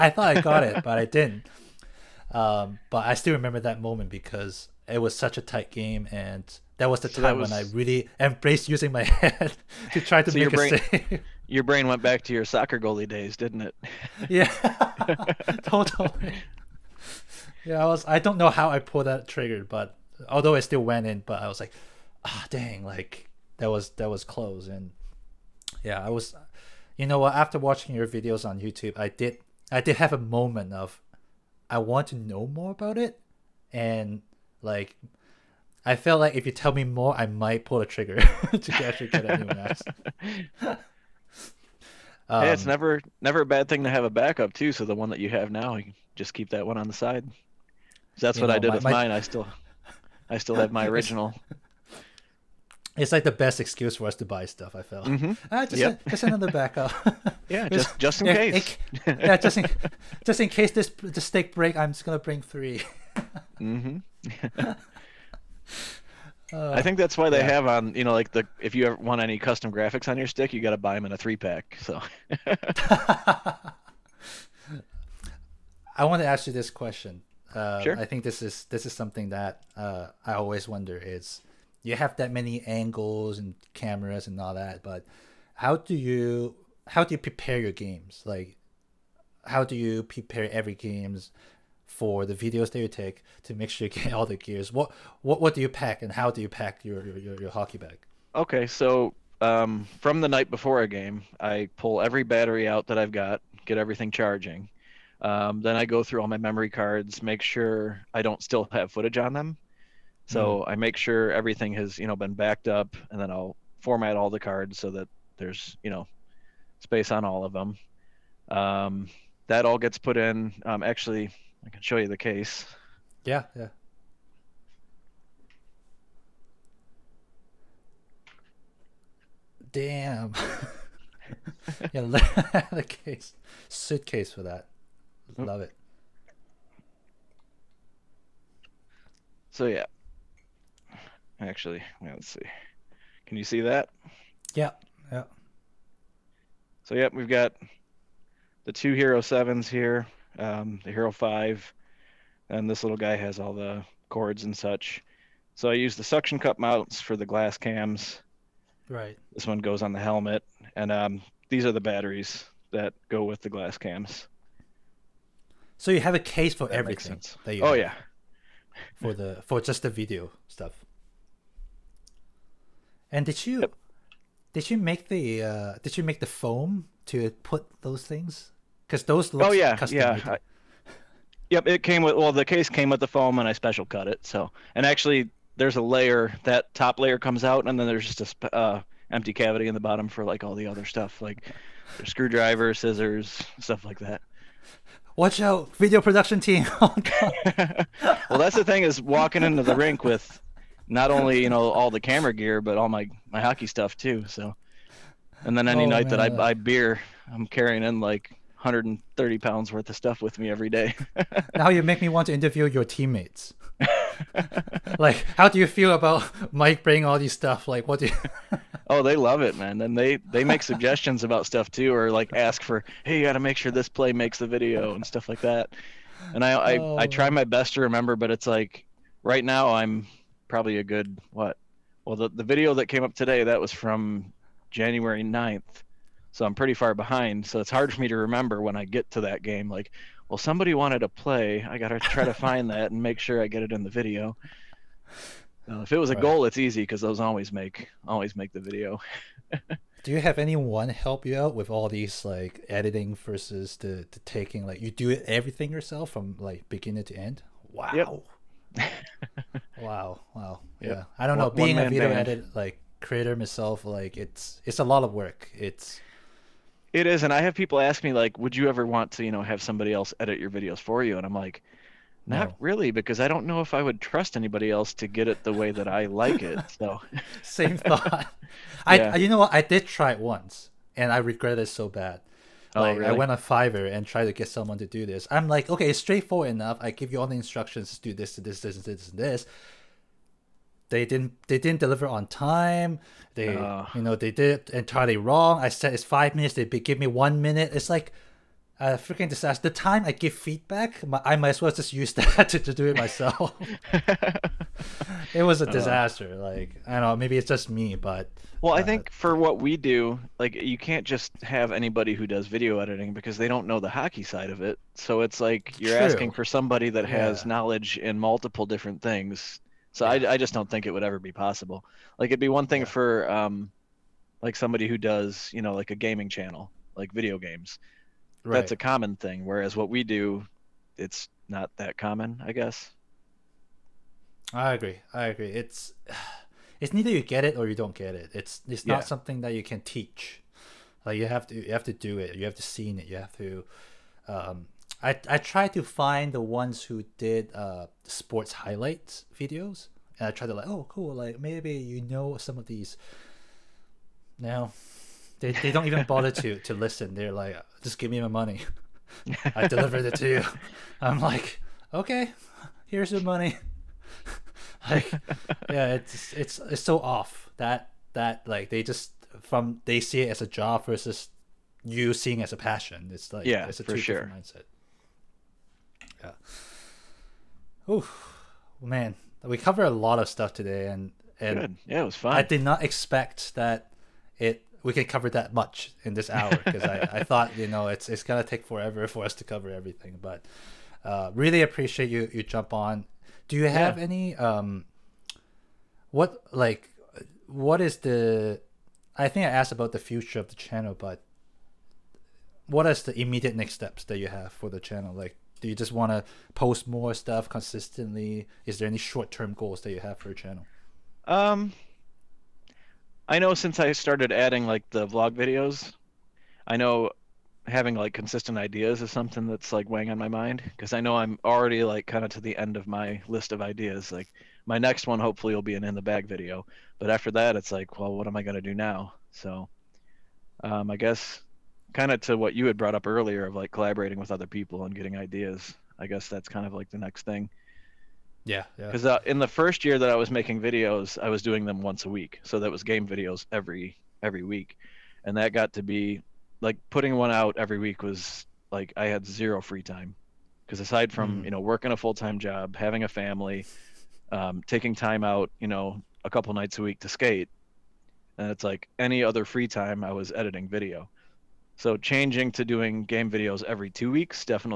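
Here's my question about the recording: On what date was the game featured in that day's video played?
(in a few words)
January 9.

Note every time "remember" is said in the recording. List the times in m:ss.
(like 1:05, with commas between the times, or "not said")
0:03, 3:47, 3:58.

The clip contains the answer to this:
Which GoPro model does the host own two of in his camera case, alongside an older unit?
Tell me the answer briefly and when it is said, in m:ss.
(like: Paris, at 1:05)
Hero 7, at 2:28.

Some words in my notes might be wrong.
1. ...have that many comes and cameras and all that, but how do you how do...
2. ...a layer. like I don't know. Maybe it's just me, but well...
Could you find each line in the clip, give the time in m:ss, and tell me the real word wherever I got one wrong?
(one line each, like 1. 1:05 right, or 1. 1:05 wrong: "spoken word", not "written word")
1. 1:21 wrong: "angles", not "comes"
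2. 5:05 wrong: "disaster", not "layer".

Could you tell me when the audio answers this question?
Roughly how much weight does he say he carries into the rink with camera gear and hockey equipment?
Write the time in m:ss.
3:28.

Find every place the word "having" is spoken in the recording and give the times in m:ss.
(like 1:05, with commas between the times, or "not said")
6:57, 7:32.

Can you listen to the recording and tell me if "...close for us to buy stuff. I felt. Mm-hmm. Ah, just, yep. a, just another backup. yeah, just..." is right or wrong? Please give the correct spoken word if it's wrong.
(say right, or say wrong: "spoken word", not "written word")
wrong: "excuse", not "close".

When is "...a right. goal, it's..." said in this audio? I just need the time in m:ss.
4:06.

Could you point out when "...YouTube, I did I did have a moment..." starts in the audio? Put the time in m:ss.
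0:28.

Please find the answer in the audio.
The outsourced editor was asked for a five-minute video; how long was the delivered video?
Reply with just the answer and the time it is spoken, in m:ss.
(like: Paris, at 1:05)
1 minute, at 4:57.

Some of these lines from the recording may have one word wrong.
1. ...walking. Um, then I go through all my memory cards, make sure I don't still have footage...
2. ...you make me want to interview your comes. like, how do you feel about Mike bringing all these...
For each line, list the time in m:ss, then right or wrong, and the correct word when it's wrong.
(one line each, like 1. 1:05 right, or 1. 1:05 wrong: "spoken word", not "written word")
1. 1:44 wrong: "charging", not "walking"
2. 3:31 wrong: "teammates", not "comes".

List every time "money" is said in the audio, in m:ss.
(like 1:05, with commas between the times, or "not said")
5:58, 6:03.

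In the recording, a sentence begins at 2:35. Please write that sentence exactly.
So I use the suction cup mounts for the glass cams.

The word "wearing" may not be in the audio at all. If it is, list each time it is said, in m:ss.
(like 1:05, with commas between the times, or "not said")
not said.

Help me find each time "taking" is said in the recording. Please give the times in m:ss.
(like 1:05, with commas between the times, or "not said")
4:14, 7:34.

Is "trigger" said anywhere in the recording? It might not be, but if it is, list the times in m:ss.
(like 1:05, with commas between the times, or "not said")
0:19, 0:37.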